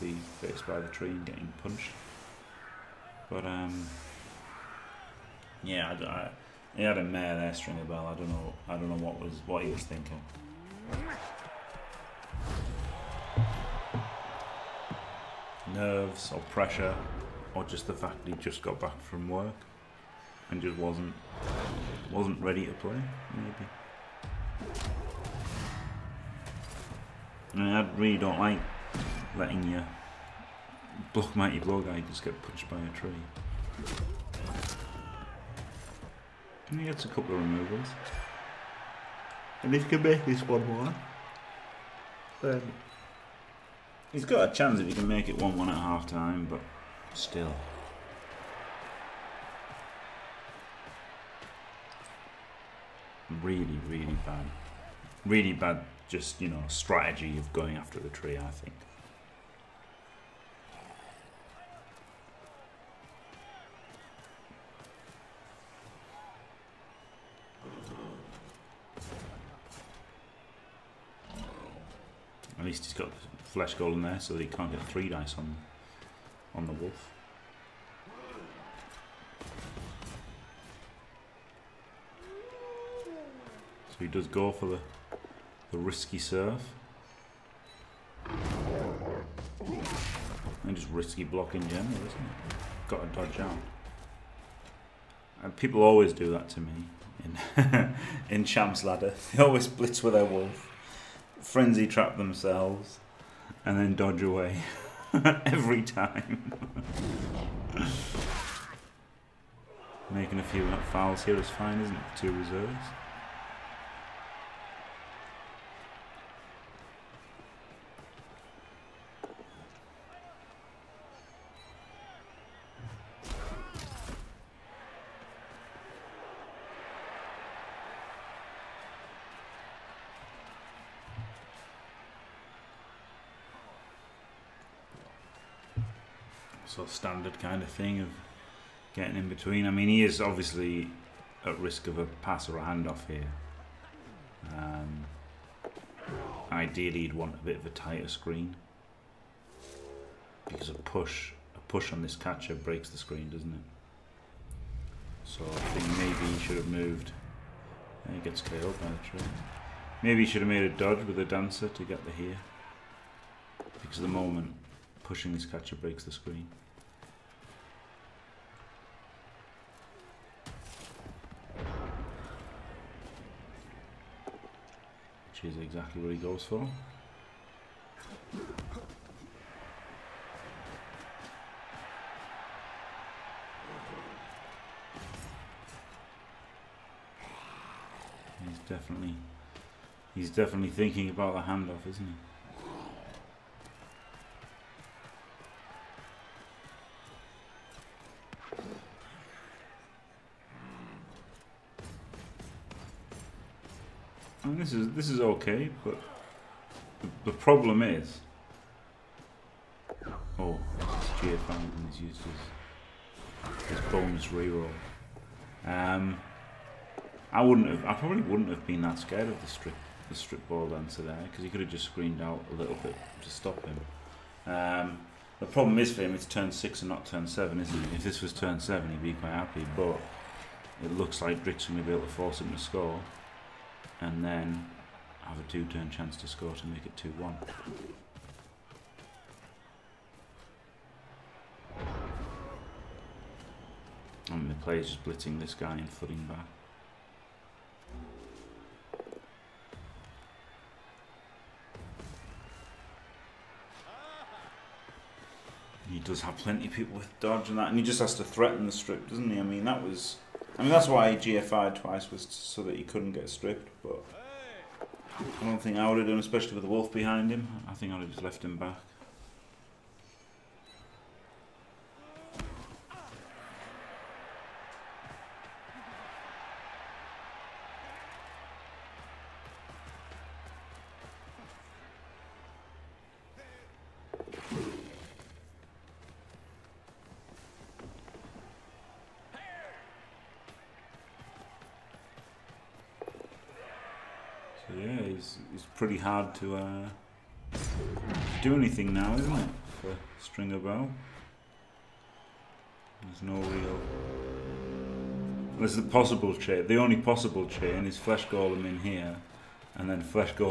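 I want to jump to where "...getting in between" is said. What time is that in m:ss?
2:18.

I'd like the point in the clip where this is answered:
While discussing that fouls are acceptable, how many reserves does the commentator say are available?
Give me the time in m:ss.
1:52.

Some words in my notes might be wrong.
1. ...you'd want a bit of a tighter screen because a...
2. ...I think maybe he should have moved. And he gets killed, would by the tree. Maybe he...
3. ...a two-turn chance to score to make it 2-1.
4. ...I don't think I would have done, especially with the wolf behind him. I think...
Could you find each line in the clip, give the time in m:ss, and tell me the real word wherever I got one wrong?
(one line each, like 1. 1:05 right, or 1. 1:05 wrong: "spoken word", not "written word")
1. 2:27 right
2. 2:35 right
3. 3:55 right
4. 4:25 right.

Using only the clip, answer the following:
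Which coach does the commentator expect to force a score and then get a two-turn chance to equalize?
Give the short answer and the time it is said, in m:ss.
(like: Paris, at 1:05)
Drikk, at 3:51.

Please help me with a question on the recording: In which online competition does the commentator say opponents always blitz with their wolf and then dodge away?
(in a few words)
Champ's Ladder.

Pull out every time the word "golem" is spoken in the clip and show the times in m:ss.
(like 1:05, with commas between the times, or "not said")
1:13, 5:08.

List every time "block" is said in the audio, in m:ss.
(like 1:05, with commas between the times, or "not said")
0:31, 1:31.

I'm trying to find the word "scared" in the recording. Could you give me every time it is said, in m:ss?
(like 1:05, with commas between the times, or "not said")
3:38.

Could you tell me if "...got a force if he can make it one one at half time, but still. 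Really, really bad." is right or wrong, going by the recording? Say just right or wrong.
wrong.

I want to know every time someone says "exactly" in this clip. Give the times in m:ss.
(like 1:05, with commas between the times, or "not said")
2:55.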